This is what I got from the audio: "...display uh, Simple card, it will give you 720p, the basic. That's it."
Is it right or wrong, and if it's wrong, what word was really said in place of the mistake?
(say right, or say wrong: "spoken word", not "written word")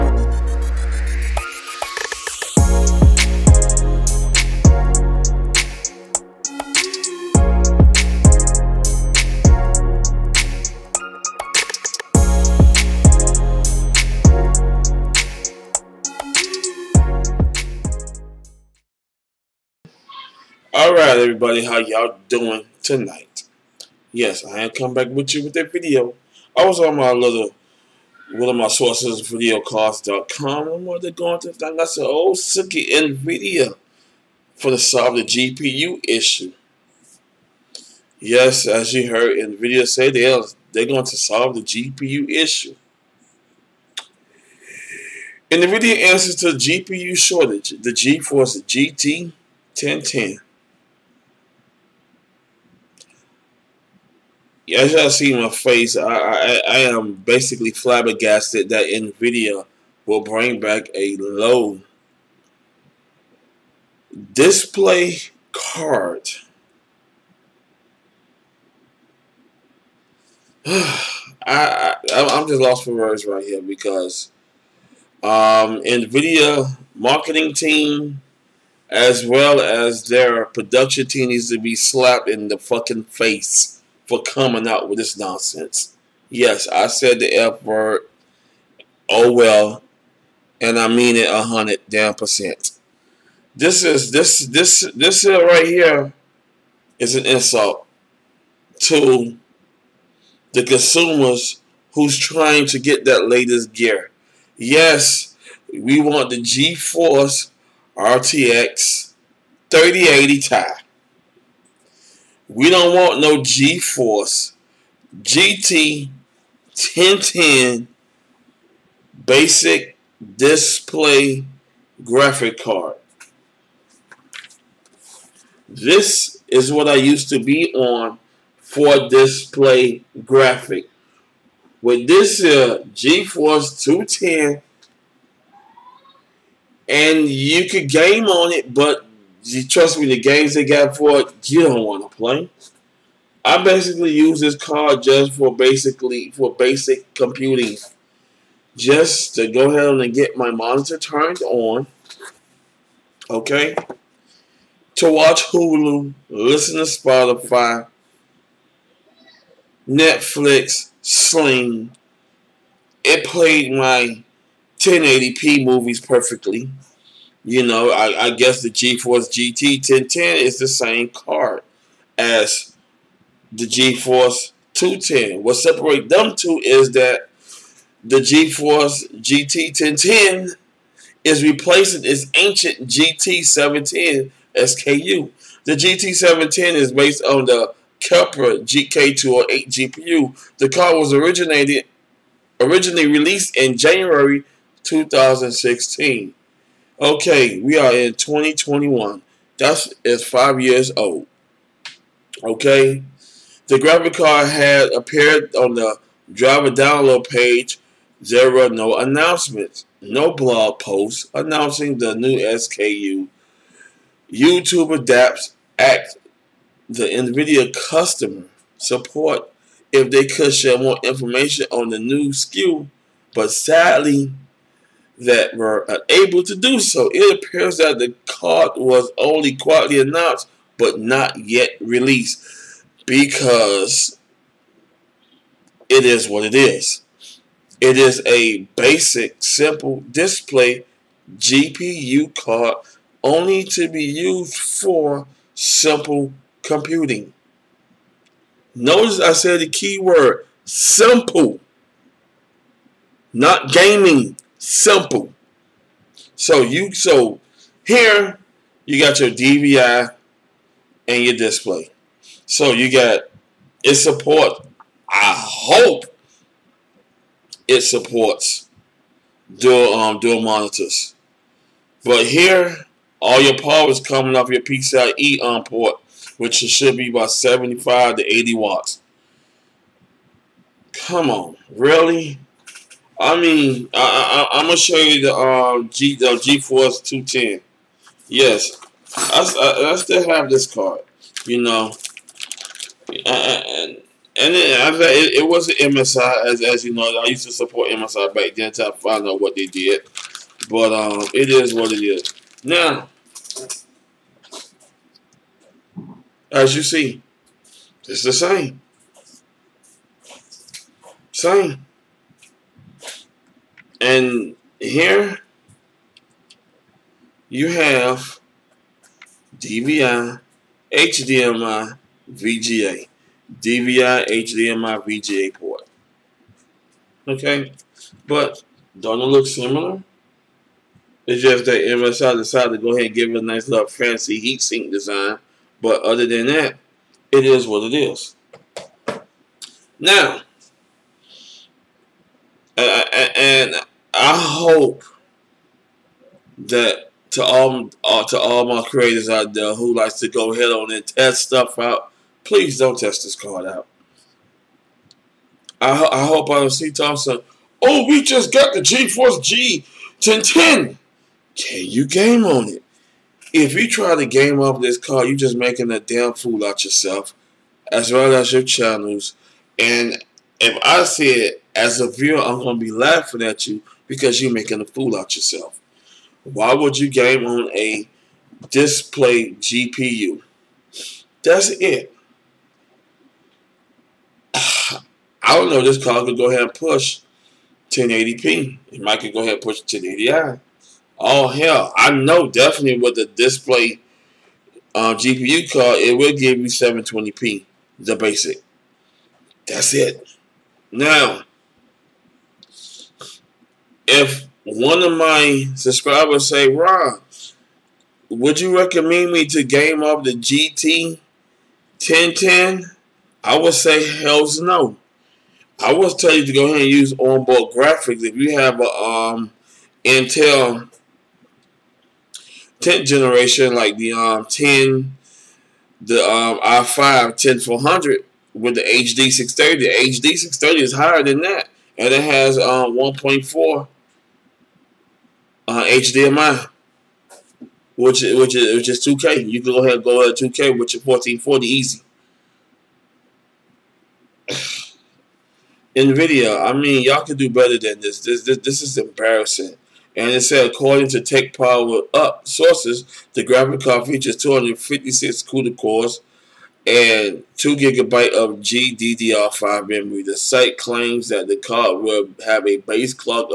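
wrong: "GPU", not "Simple".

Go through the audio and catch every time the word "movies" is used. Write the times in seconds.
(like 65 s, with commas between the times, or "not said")
165 s.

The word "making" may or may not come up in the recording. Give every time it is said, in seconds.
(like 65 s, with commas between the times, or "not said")
365 s, 374 s.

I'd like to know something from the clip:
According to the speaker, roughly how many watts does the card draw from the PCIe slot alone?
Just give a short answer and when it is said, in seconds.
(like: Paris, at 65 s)
75 to 80 watts, at 277 s.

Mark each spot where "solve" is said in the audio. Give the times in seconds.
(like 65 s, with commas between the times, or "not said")
34 s, 41 s.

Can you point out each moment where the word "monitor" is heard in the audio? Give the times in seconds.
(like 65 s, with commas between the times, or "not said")
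150 s, 270 s.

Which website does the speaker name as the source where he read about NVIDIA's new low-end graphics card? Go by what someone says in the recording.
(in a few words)
videocardz.com.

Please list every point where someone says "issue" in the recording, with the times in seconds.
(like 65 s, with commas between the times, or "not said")
36 s, 42 s.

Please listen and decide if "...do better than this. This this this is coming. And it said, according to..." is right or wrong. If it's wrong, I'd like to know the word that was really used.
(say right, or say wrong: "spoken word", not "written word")
wrong: "embarrassing", not "coming".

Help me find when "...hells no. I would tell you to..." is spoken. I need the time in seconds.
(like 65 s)
414 s.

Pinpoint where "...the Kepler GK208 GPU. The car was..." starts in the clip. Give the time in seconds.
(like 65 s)
187 s.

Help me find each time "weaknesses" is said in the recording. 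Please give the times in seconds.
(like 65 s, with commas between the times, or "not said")
not said.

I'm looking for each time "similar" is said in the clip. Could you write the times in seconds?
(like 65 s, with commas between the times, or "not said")
329 s.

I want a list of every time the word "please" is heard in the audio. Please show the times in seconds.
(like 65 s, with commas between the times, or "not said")
352 s.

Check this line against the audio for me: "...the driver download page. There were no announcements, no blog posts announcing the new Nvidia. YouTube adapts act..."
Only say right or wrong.
wrong.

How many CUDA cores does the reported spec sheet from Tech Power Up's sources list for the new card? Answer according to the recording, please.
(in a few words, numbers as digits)
256.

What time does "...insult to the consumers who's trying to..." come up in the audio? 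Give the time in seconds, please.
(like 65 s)
97 s.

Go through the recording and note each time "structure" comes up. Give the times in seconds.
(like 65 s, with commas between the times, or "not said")
not said.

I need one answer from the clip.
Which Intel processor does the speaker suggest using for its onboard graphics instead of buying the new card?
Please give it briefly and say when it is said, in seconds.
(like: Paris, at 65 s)
i5 10400, at 426 s.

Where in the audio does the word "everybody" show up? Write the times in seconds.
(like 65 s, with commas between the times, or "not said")
21 s.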